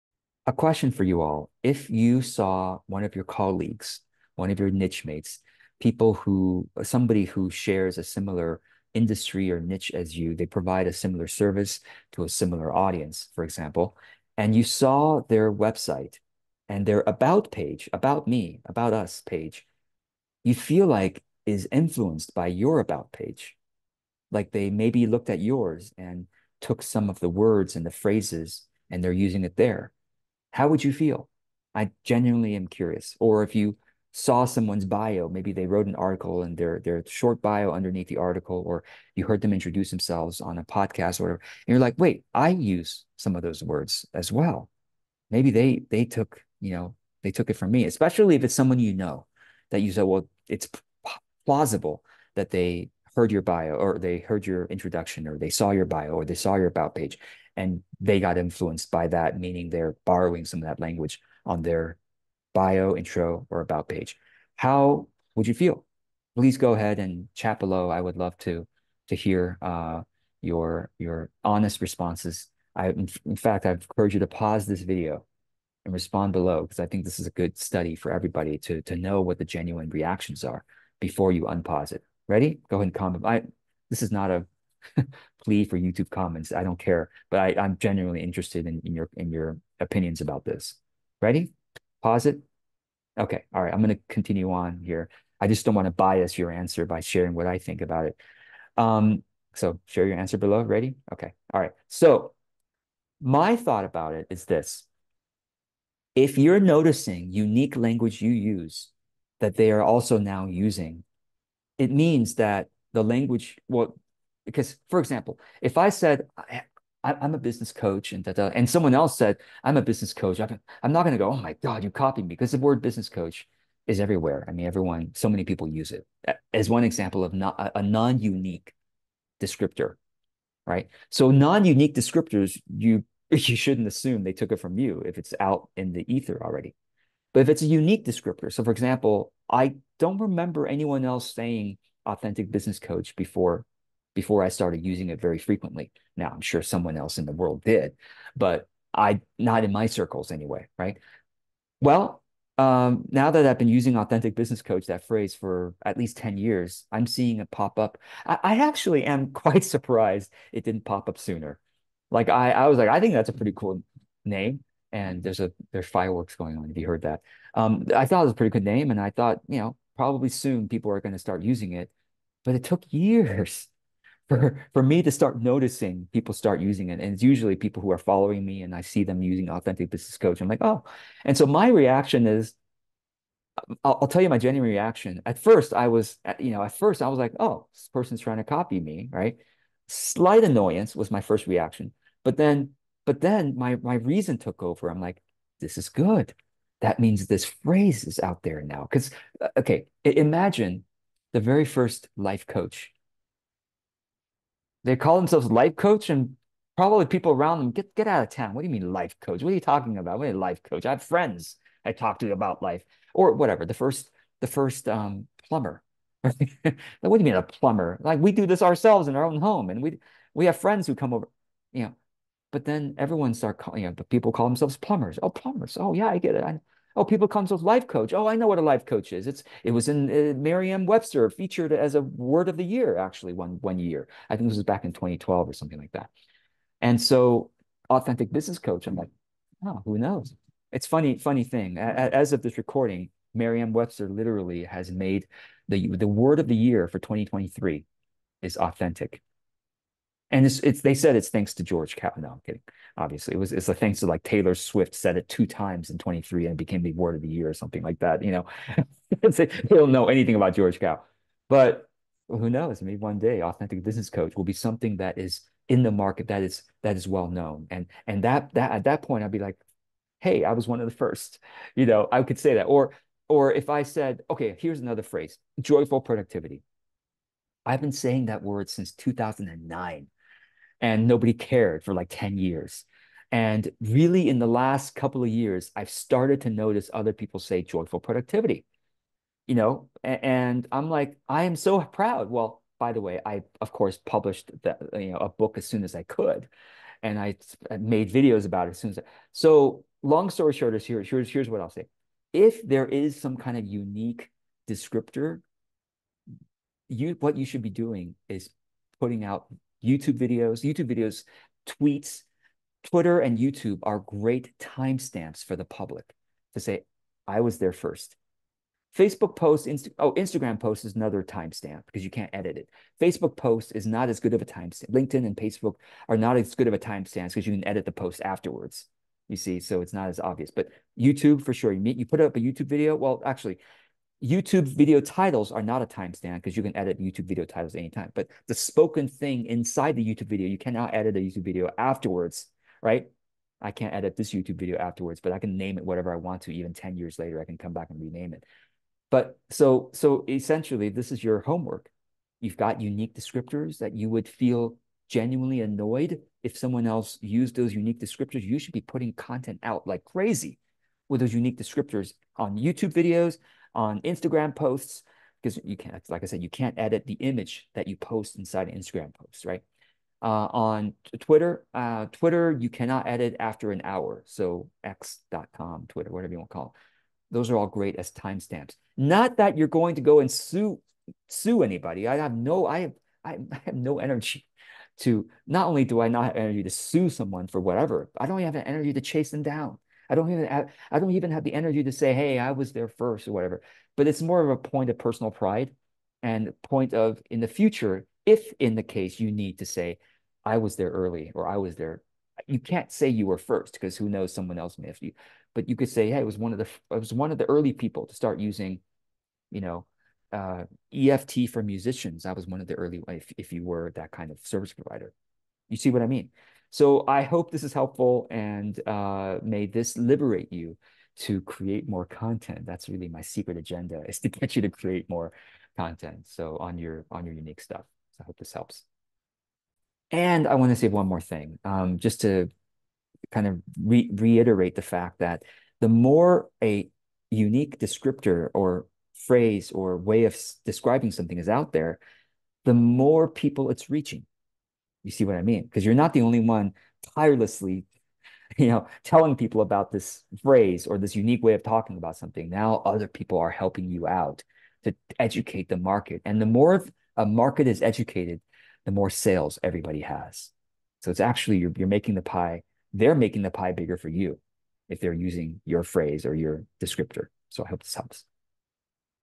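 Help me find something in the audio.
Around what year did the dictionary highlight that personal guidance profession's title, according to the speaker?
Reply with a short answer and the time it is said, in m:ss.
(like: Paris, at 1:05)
2012, at 3:54.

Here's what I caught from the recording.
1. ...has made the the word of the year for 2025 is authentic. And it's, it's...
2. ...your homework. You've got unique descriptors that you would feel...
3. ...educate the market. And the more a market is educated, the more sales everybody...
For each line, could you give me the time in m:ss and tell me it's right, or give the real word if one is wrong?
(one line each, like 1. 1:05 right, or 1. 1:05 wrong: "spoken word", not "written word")
1. 4:04 wrong: "2023", not "2025"
2. 5:51 right
3. 7:35 right.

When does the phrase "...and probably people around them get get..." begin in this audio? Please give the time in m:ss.
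3:26.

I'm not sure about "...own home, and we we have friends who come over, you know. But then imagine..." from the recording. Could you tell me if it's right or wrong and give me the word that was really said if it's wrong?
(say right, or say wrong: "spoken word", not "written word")
wrong: "everyone", not "imagine".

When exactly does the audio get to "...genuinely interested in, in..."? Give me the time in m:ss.
1:27.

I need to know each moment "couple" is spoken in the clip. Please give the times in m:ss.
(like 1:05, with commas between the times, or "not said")
4:44.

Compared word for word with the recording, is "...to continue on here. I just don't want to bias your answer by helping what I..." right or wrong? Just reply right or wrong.
wrong.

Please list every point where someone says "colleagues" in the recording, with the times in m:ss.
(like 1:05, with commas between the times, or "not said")
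0:03.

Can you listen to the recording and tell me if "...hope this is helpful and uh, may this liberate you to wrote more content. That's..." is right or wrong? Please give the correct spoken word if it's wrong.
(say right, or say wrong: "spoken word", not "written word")
wrong: "create", not "wrote".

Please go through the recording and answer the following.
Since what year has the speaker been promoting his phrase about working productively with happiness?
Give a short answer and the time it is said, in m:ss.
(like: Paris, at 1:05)
2009, at 4:38.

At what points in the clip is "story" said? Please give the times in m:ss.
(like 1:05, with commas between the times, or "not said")
5:00.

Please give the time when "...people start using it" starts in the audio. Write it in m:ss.
2:56.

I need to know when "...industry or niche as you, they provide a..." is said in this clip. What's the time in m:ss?
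0:08.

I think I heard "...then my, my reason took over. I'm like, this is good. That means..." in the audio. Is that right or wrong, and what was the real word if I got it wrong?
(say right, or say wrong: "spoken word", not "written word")
right.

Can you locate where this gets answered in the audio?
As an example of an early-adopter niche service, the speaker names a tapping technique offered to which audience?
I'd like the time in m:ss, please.
6:50.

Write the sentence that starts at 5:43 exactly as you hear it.
I can't edit this YouTube video afterwards, but I can name it whatever I want to.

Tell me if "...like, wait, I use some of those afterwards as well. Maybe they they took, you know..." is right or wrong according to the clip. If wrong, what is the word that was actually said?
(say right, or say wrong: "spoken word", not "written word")
wrong: "words", not "afterwards".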